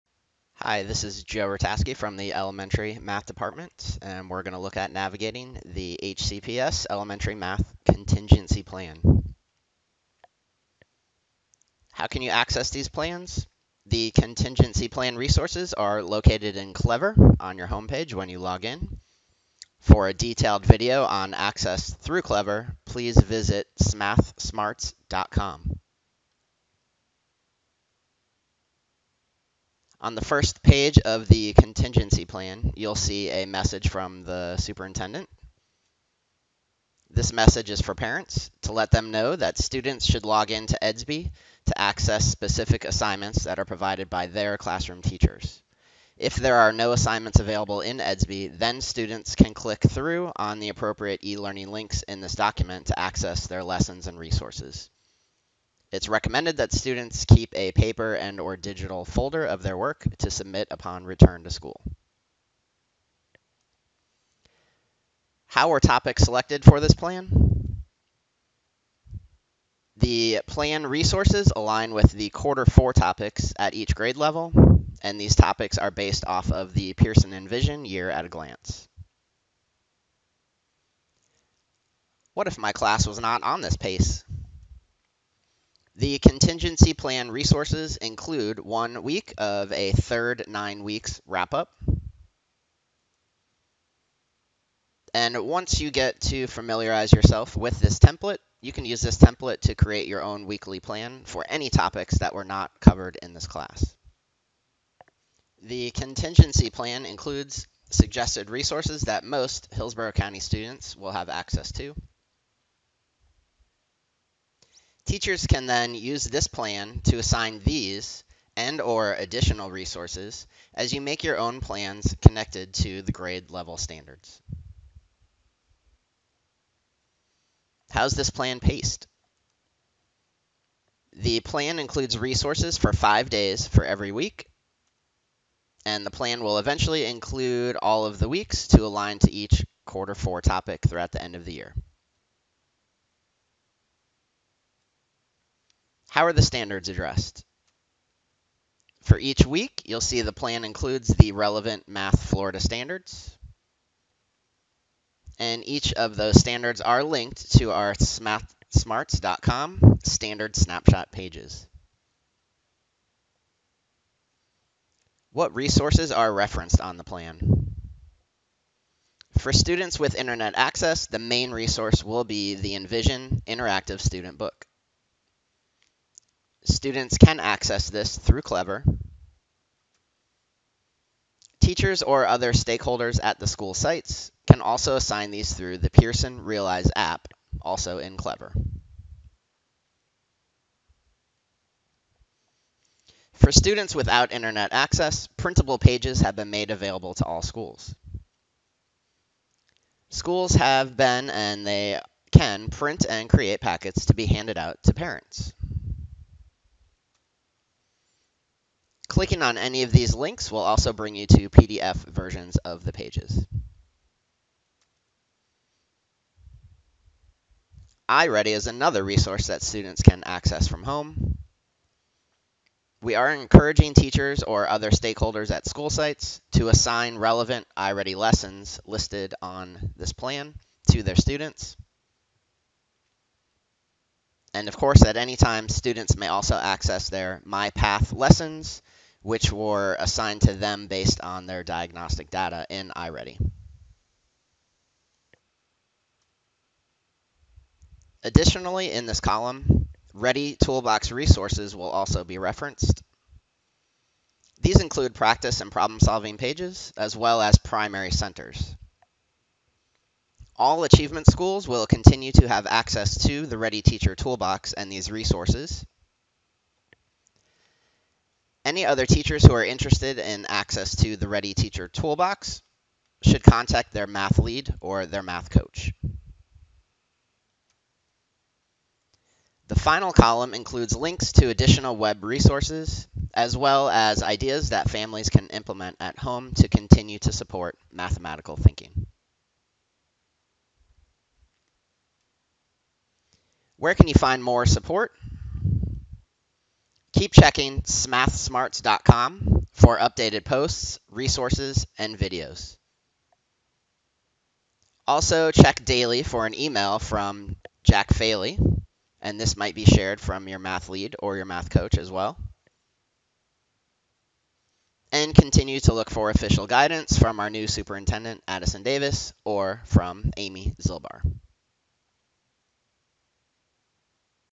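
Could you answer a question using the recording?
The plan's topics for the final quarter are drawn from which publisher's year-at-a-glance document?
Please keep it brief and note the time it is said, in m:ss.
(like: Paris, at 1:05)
Pearson Envision, at 1:16.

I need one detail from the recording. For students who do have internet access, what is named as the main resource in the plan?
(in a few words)
Envision Interactive Student Book.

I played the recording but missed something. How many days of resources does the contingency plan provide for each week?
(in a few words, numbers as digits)
5.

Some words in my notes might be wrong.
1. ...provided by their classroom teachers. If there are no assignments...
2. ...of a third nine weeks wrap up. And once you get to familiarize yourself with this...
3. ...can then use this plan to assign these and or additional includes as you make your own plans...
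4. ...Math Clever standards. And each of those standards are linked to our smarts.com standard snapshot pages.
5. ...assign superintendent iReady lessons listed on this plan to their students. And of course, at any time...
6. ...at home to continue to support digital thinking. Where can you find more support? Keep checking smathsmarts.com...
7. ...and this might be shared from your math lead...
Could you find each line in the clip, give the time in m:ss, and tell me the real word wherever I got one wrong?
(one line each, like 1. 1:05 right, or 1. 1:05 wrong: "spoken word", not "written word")
1. 0:43 right
2. 1:29 right
3. 1:55 wrong: "resources", not "includes"
4. 2:31 wrong: "Florida", not "Clever"
5. 3:46 wrong: "relevant", not "superintendent"
6. 4:45 wrong: "mathematical", not "digital"
7. 5:09 right.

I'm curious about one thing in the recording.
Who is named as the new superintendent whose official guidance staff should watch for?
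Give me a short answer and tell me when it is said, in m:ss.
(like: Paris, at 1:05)
Addison Davis, at 5:18.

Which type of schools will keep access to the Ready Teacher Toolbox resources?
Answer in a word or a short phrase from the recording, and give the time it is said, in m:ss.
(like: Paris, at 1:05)
Achievement schools, at 4:20.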